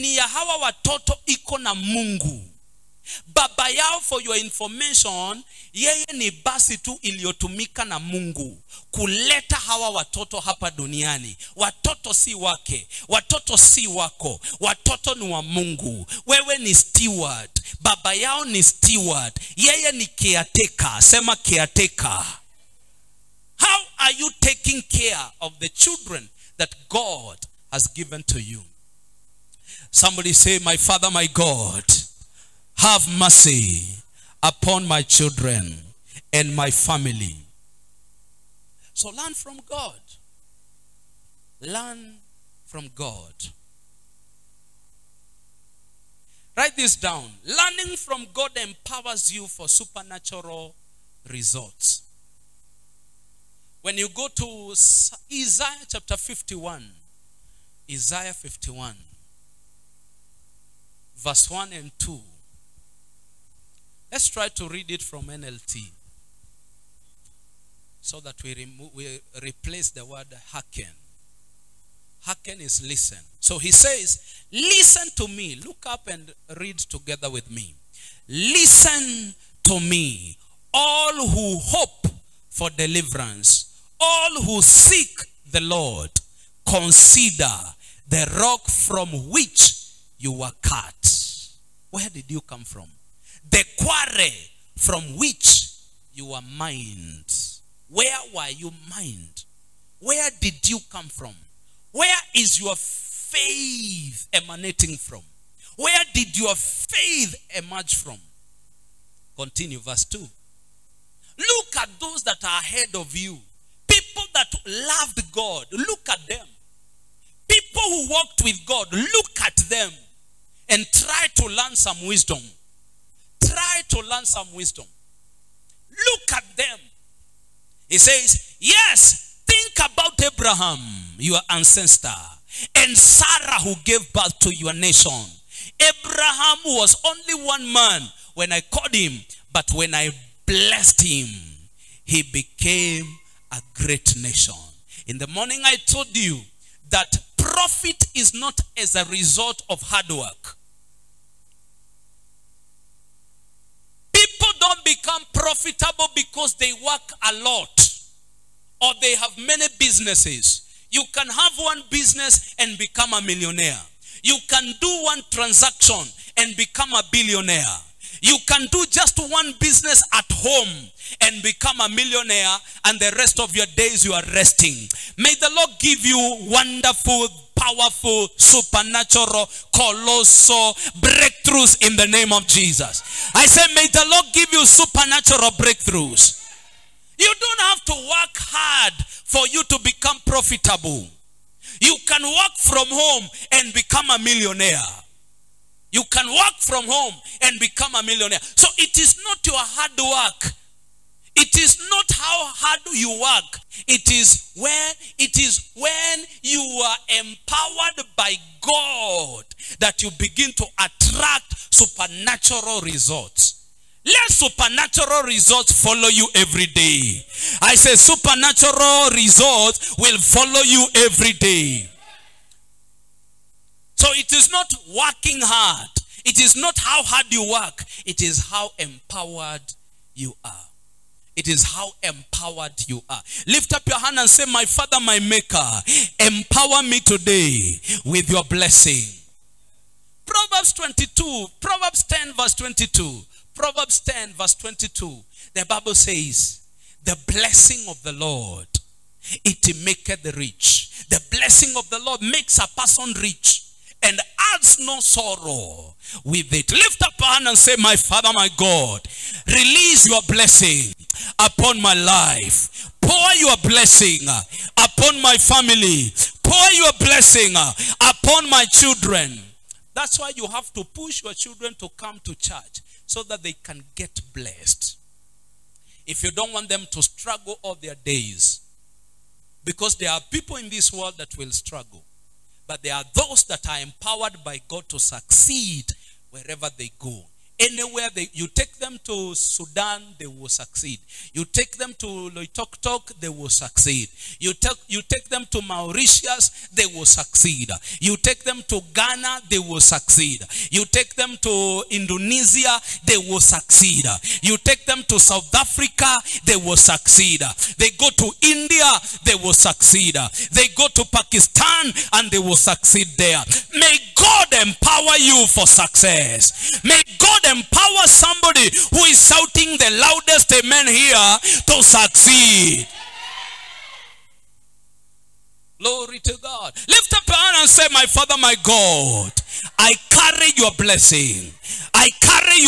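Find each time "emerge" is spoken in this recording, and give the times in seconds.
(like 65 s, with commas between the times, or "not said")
107 s.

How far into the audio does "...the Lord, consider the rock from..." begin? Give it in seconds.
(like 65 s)
85 s.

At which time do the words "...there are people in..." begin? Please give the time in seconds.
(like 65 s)
279 s.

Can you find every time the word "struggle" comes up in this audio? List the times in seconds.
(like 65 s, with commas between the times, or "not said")
277 s, 281 s.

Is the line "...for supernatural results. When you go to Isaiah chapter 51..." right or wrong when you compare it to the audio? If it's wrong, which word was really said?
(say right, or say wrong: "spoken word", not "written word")
right.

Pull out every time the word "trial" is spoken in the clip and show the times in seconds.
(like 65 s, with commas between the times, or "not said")
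not said.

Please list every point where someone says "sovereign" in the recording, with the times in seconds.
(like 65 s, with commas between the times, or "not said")
not said.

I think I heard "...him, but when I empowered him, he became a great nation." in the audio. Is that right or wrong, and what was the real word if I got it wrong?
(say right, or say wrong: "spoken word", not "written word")
wrong: "blessed", not "empowered".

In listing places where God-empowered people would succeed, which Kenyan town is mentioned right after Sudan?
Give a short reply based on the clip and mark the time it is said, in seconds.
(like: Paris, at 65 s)
Loitoktok, at 292 s.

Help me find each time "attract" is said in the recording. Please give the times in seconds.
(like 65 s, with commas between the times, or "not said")
210 s.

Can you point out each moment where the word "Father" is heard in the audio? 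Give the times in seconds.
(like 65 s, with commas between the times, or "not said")
30 s, 234 s, 257 s, 328 s.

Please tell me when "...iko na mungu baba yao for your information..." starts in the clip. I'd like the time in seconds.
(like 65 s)
1 s.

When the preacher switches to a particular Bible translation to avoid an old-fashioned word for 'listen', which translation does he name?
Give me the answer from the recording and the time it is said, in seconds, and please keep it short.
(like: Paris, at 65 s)
NLT, at 65 s.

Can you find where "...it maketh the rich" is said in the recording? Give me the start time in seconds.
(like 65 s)
249 s.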